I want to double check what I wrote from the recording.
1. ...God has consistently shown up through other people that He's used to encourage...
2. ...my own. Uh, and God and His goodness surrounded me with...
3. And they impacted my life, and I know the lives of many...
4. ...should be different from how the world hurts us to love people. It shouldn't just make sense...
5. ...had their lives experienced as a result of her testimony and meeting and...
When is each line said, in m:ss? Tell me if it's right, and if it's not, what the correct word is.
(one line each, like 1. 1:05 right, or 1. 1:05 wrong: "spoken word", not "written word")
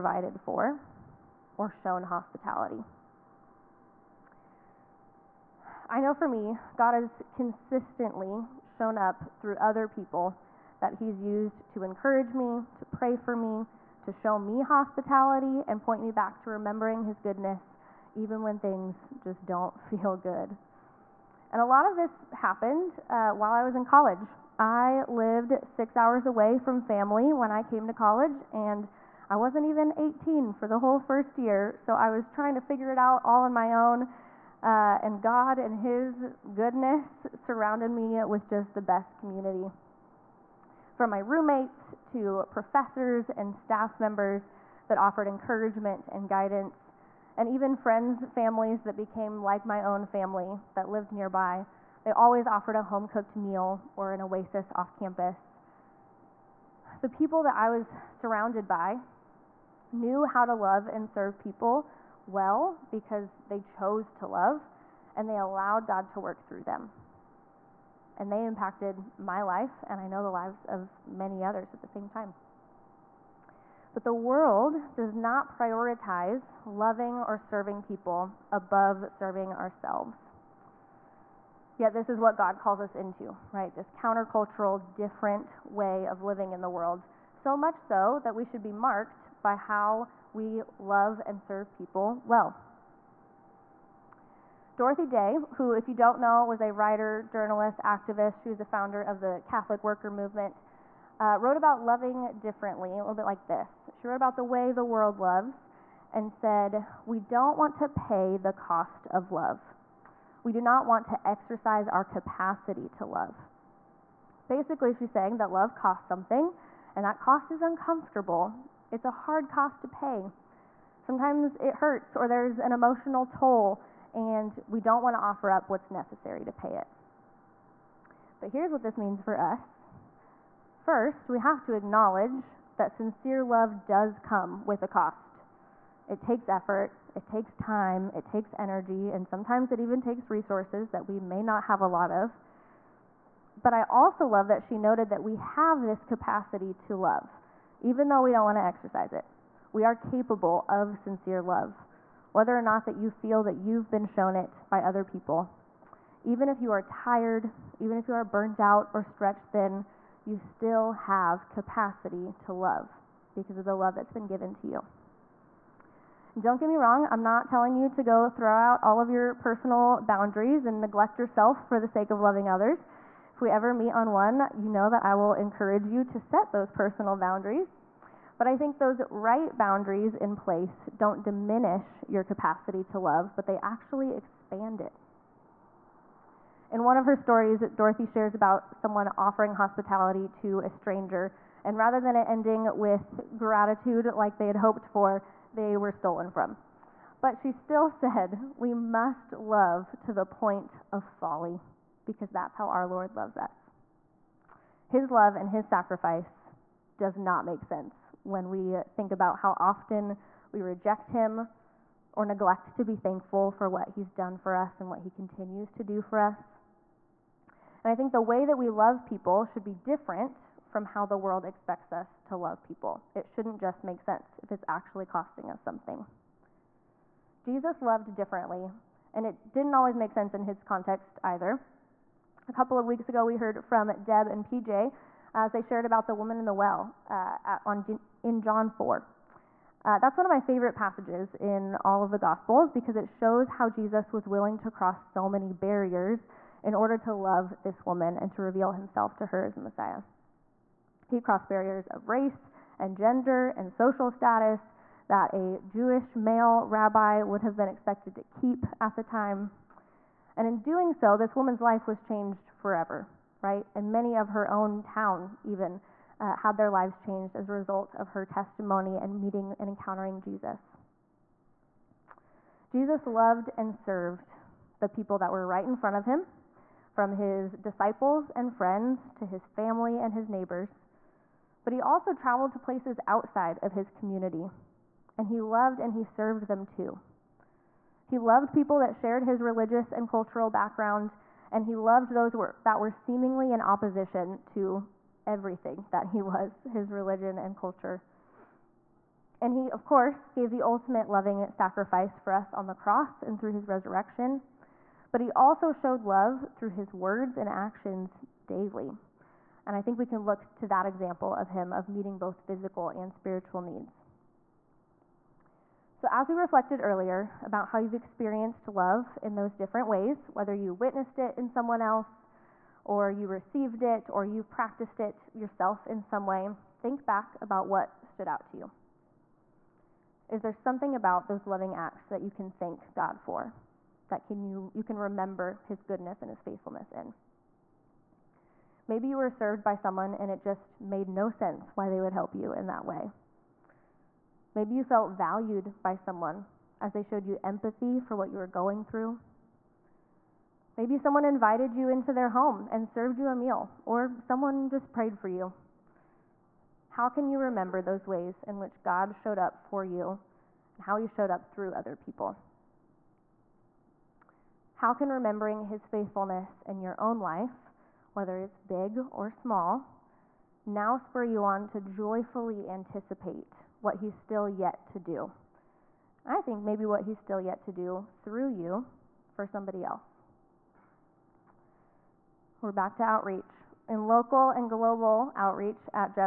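1. 0:06 right
2. 0:33 right
3. 1:08 right
4. 3:39 wrong: "expects", not "hurts"
5. 4:26 wrong: "changed", not "experienced".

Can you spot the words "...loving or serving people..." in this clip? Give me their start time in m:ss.
1:16.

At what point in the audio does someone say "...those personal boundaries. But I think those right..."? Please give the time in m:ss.
2:56.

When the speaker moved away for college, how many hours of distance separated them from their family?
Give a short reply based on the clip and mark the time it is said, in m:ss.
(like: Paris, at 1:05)
6, at 0:25.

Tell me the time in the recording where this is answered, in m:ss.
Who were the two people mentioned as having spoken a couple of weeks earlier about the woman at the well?
3:54.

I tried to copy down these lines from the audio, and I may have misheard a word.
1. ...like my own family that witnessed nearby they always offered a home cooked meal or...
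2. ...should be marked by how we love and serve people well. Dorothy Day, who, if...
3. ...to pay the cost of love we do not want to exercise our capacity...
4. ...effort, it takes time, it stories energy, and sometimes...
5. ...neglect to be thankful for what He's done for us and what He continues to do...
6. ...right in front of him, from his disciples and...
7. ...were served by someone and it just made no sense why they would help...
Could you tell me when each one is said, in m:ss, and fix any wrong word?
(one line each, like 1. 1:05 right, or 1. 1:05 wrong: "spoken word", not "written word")
1. 0:49 wrong: "lived", not "witnessed"
2. 1:28 right
3. 1:47 right
4. 2:16 wrong: "takes", not "stories"
5. 3:32 right
6. 4:35 right
7. 5:39 right.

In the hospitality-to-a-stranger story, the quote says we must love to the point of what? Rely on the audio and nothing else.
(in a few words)
folly.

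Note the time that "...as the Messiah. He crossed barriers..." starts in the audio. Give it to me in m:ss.
4:09.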